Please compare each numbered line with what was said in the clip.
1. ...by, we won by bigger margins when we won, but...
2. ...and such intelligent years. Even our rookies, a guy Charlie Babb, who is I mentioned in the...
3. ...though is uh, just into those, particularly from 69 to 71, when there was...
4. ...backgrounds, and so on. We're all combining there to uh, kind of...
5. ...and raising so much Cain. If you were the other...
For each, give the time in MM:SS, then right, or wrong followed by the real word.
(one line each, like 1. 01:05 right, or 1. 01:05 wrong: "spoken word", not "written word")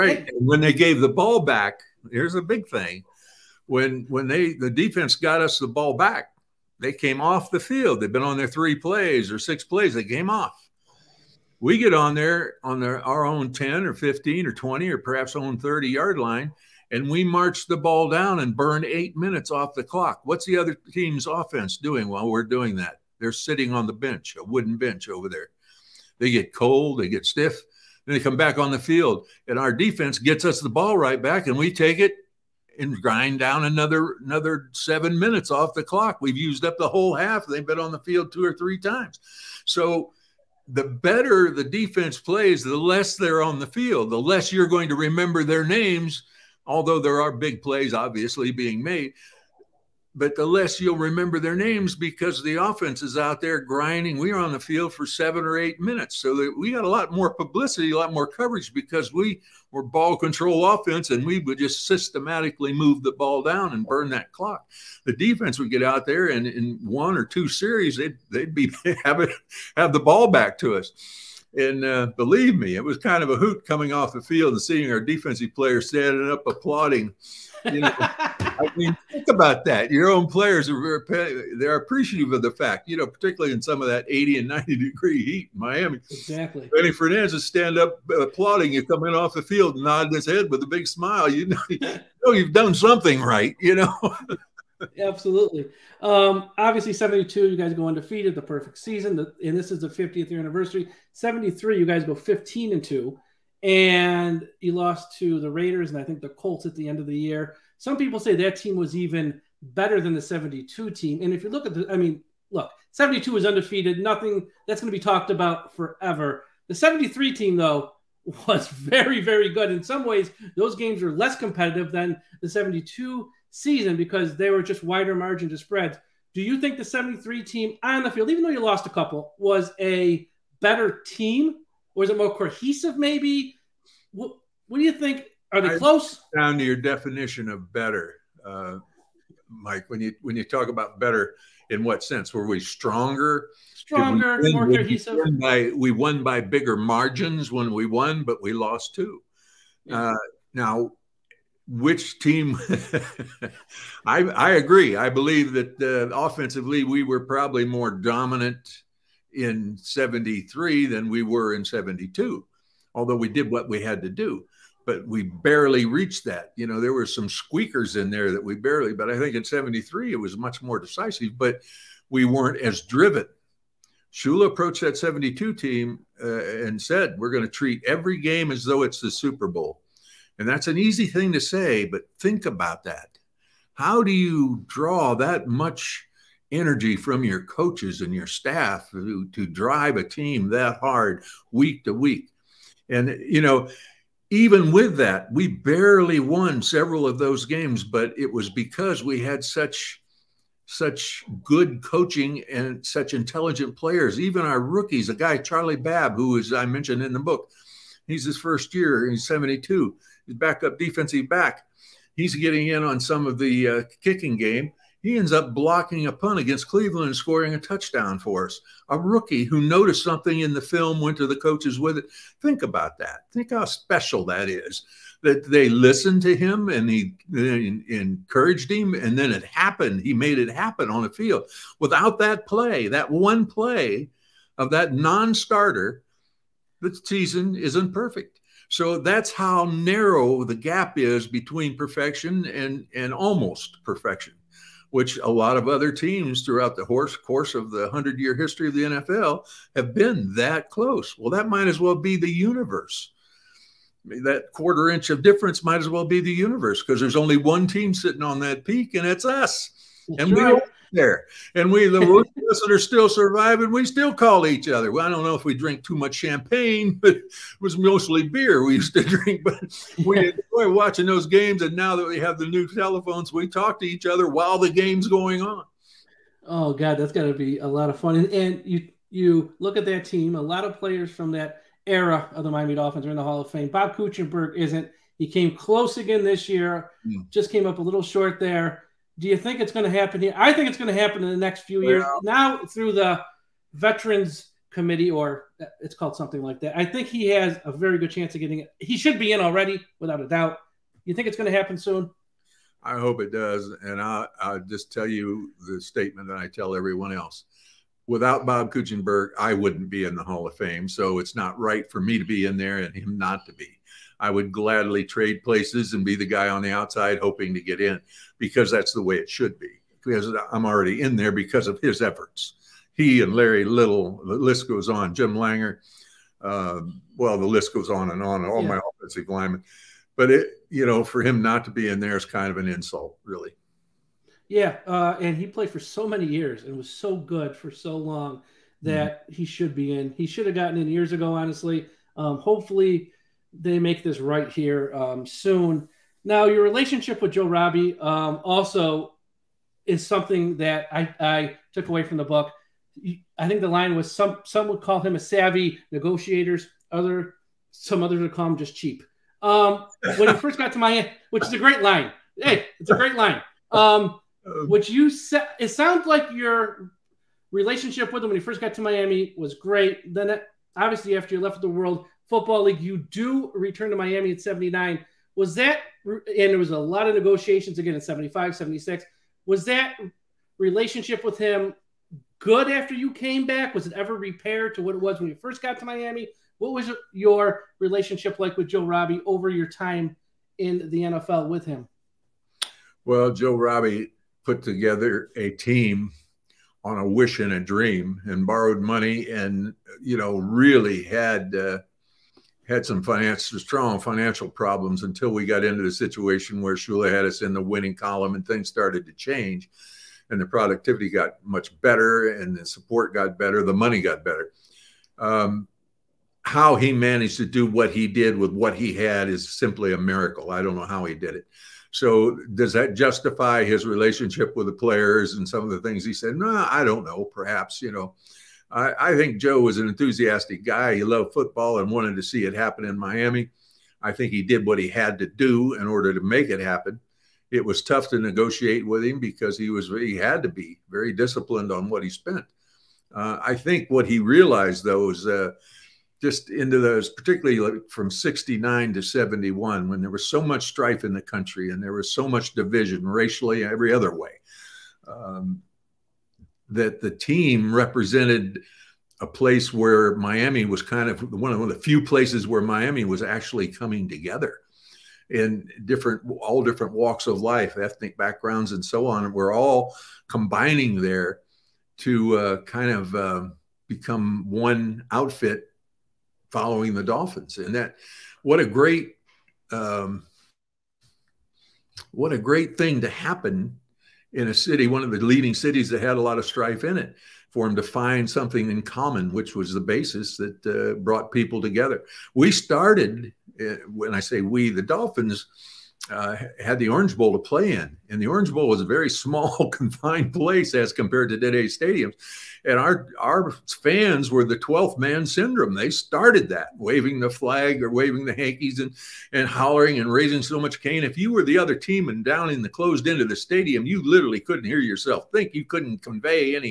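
1. 02:25 right
2. 03:22 wrong: "players", not "years"
3. 07:24 right
4. 07:48 right
5. 08:29 right.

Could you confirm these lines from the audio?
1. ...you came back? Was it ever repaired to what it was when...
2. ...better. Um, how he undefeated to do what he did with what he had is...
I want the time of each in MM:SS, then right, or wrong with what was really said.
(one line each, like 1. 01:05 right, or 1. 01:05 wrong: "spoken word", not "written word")
1. 06:22 right
2. 06:54 wrong: "managed", not "undefeated".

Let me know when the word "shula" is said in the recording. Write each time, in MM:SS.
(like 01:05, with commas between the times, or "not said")
02:54, 06:46.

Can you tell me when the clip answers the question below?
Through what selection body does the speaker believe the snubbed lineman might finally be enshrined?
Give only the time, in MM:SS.
04:53.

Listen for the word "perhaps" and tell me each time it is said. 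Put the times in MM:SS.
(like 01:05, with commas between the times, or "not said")
00:14, 07:07.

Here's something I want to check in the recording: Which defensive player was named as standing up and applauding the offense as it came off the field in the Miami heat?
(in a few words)
Manny Fernandez.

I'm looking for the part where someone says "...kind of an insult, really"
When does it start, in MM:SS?
05:32.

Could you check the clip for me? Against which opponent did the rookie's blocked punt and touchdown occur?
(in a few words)
Cleveland.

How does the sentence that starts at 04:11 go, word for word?
Well, that might as well be the universe.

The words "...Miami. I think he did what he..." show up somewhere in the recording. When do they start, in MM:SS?
07:12.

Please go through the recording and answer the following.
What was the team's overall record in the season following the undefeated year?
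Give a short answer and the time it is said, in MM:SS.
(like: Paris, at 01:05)
15 and 2, at 01:42.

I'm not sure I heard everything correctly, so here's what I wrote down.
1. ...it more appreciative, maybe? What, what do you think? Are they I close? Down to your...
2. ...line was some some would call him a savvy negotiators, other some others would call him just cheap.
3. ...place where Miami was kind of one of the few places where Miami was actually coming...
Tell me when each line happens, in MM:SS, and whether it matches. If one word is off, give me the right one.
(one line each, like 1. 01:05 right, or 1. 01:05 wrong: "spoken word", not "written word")
1. 02:12 wrong: "cohesive", not "appreciative"
2. 05:53 right
3. 07:39 right.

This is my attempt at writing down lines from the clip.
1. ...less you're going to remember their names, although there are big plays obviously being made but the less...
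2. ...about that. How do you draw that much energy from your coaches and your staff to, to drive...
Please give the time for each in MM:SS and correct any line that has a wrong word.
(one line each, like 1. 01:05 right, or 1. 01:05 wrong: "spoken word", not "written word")
1. 00:44 right
2. 03:02 right.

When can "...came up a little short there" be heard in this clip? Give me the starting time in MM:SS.
04:47.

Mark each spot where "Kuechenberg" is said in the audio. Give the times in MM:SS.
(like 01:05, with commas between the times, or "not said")
04:43, 05:08.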